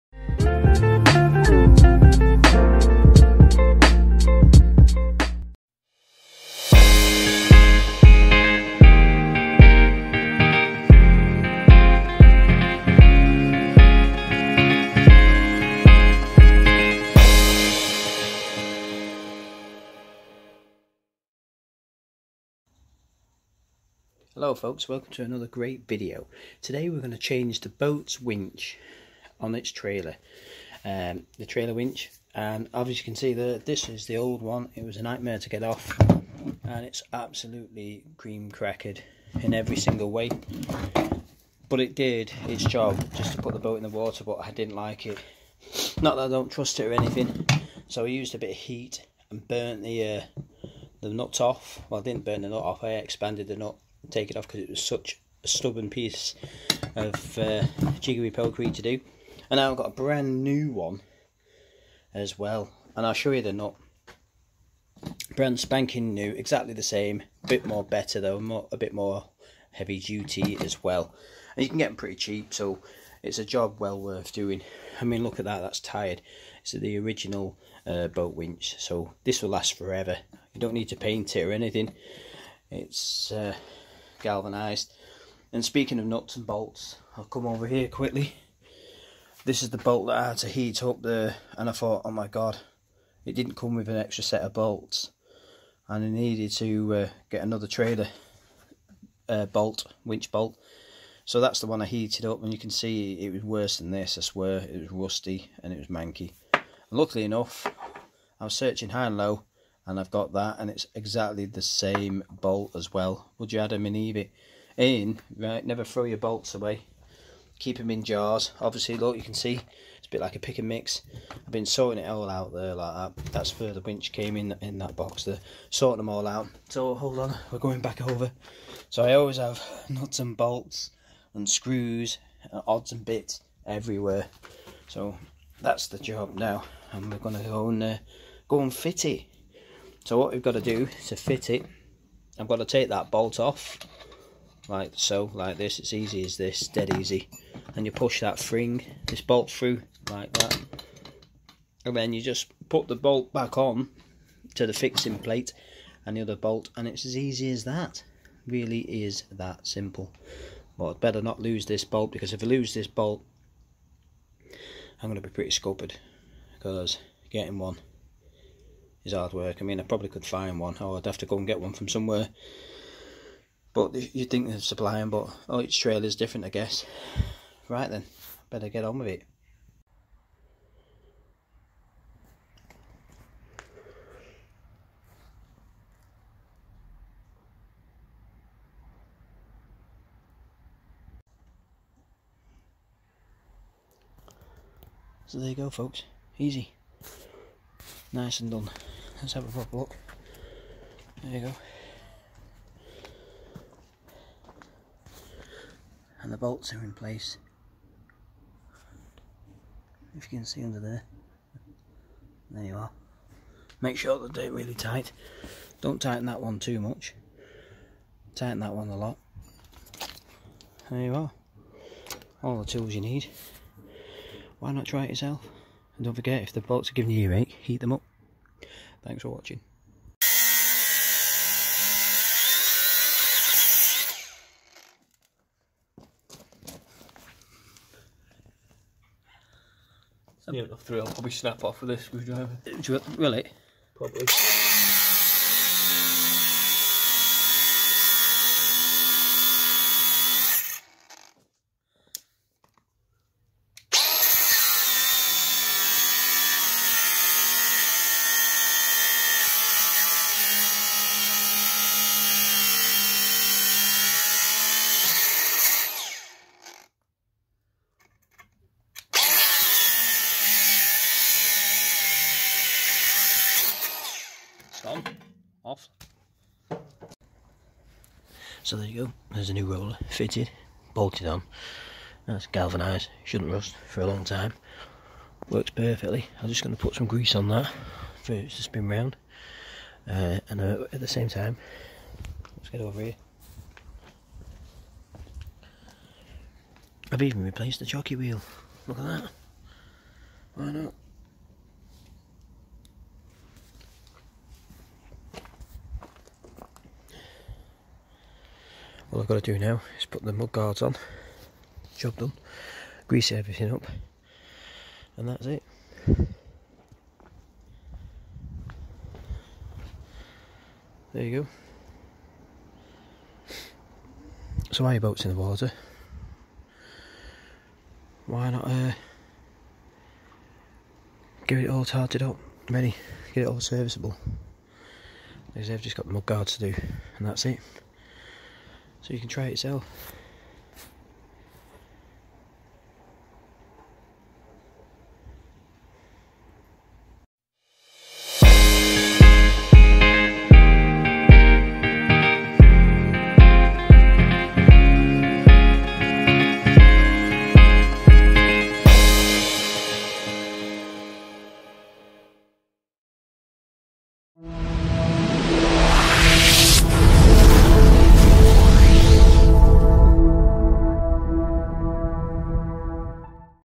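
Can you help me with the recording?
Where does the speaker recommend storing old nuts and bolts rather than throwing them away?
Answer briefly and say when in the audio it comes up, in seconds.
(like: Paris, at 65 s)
In jars, at 117 s.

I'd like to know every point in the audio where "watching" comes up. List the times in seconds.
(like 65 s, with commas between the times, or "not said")
229 s.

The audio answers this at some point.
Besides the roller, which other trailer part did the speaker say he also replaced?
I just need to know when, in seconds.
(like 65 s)
297 s.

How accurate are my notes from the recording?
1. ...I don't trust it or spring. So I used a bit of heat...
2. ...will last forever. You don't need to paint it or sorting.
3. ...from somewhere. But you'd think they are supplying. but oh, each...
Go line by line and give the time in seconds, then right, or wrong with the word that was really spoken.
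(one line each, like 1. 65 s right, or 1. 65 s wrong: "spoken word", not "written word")
1. 46 s wrong: "anything", not "spring"
2. 79 s wrong: "anything", not "sorting"
3. 171 s right.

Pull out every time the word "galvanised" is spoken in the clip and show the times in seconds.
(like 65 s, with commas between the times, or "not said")
84 s, 282 s.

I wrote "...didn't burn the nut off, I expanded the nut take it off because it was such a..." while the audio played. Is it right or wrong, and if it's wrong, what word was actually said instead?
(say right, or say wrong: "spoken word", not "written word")
right.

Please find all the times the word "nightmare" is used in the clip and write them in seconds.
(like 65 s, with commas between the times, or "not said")
35 s.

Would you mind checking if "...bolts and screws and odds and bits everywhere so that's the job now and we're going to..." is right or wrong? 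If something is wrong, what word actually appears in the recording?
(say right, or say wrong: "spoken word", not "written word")
right.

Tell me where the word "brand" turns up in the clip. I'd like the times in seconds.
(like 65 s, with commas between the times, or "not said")
59 s, 65 s.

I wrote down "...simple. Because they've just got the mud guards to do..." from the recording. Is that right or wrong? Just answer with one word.
wrong.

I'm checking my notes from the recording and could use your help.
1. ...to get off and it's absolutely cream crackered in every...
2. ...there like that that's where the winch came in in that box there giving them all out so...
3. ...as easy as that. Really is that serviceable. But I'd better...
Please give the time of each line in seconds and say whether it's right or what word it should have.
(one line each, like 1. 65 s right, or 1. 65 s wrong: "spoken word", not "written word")
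1. 35 s right
2. 122 s wrong: "sorting", not "giving"
3. 157 s wrong: "simple", not "serviceable".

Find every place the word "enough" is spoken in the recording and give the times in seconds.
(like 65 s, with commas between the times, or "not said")
107 s, 240 s.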